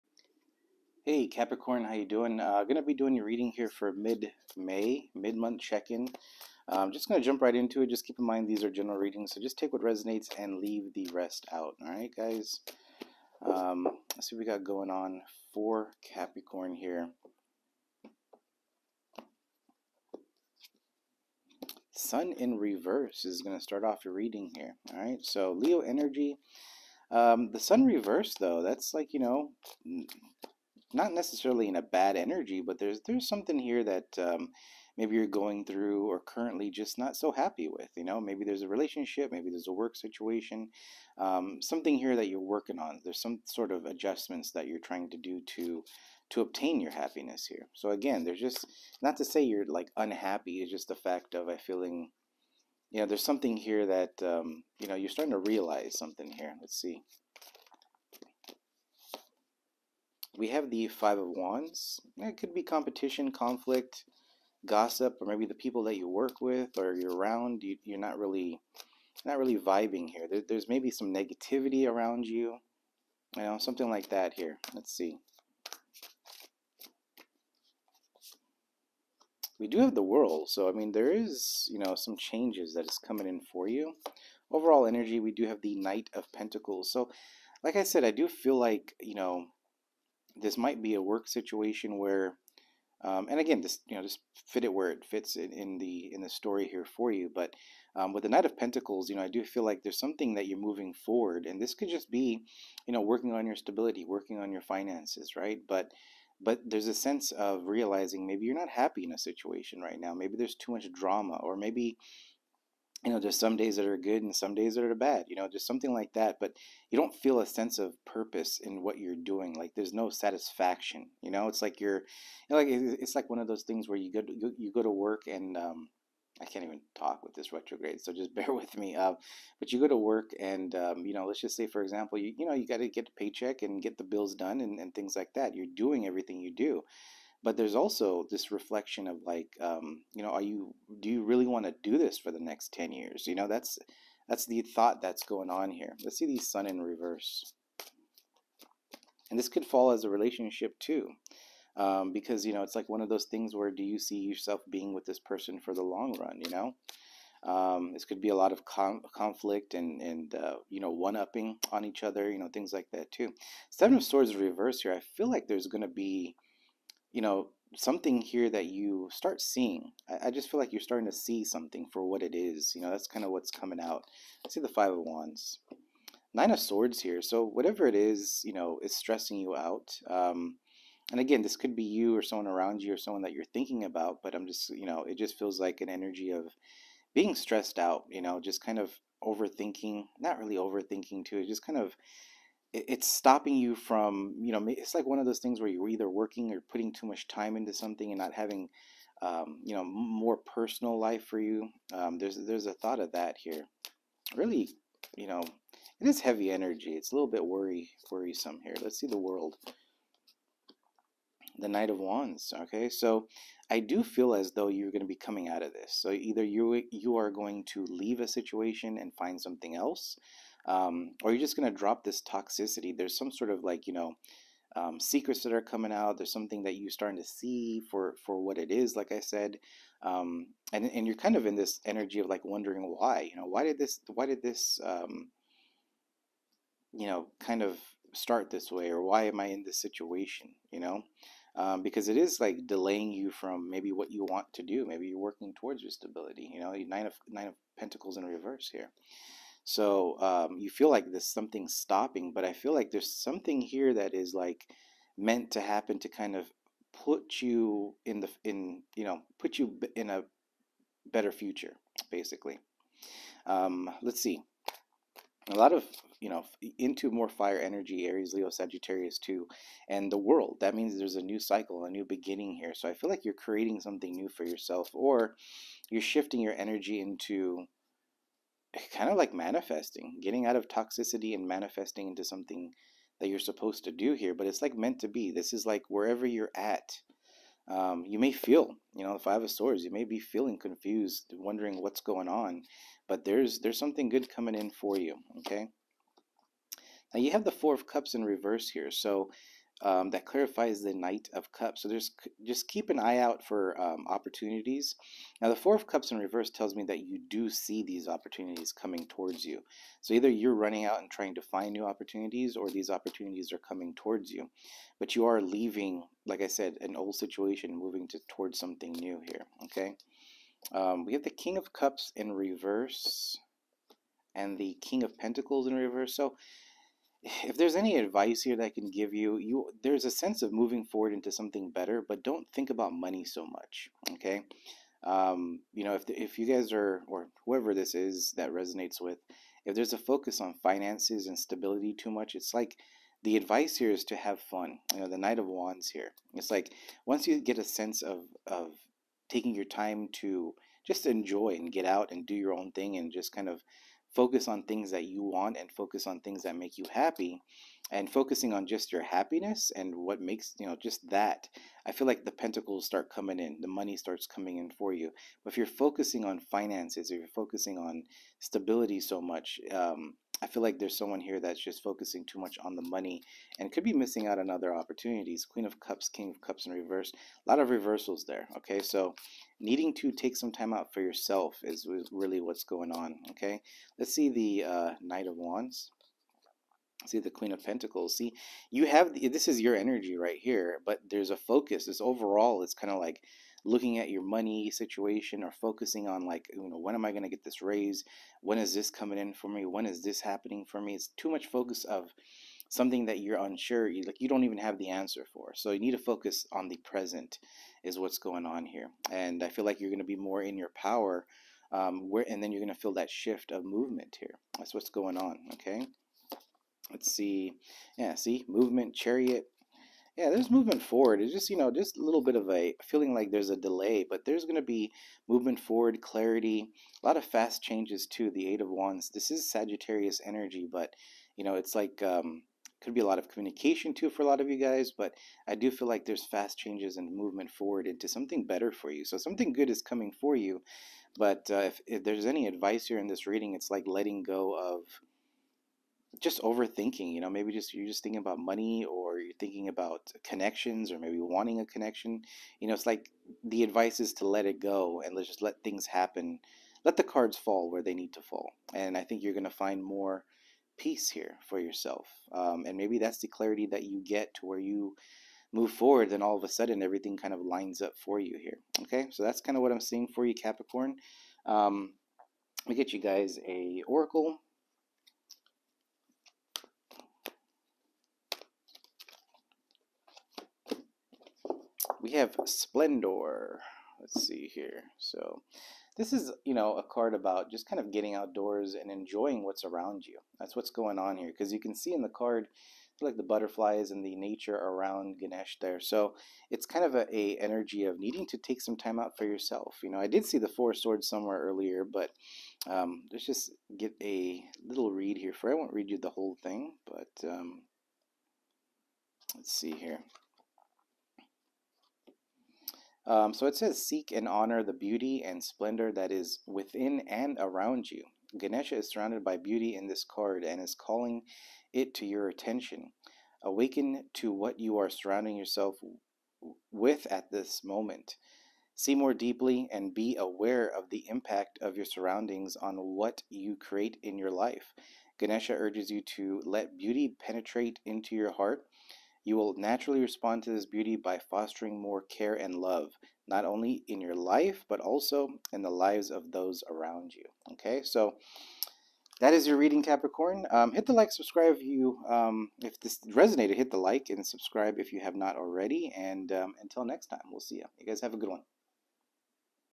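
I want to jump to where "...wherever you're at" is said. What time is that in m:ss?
4:45.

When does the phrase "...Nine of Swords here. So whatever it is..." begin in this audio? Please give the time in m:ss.
2:56.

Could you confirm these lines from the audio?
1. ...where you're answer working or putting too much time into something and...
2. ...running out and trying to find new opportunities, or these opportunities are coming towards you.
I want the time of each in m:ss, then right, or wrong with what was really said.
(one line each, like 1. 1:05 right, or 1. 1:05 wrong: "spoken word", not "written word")
1. 3:15 wrong: "either", not "answer"
2. 5:10 right.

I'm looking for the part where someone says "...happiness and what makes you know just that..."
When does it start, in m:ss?
5:59.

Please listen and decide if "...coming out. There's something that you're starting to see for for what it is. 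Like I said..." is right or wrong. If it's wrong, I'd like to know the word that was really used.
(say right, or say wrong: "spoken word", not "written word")
right.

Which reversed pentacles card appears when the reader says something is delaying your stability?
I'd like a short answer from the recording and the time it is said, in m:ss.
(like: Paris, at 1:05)
Nine of Pentacles, at 4:07.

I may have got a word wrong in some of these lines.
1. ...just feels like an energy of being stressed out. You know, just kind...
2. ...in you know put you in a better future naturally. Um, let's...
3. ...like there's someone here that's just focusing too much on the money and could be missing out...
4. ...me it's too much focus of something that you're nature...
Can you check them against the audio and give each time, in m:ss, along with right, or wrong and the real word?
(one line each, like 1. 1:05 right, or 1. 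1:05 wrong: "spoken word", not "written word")
1. 3:05 right
2. 4:18 wrong: "basically", not "naturally"
3. 6:10 right
4. 6:40 wrong: "unsure", not "nature".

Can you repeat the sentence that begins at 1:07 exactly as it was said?
You, you're not really, not really vibing here.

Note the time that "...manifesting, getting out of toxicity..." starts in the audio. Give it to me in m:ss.
4:39.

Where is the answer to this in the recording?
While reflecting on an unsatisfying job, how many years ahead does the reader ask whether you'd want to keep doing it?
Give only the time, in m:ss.
2:22.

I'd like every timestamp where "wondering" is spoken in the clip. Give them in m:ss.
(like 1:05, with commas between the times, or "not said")
3:52, 4:51.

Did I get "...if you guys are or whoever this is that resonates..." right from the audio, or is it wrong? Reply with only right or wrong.
right.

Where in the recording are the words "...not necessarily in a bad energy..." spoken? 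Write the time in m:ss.
0:30.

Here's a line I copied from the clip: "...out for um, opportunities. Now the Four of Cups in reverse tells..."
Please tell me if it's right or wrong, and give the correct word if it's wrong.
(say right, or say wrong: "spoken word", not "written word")
right.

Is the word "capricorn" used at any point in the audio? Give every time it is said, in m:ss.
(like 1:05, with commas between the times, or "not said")
0:01, 0:16, 7:50, 9:09.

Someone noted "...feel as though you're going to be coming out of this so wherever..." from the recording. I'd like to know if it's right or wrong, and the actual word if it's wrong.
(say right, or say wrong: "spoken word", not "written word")
wrong: "either", not "wherever".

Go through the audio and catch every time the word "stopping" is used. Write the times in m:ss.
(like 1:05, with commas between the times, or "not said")
3:13, 4:11.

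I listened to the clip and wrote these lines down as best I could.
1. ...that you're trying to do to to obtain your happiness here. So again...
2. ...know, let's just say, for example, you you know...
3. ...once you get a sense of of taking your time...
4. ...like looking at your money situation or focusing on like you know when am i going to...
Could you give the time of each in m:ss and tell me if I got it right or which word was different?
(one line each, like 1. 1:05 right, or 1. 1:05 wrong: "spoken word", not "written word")
1. 0:44 right
2. 2:11 right
3. 5:47 right
4. 6:32 right.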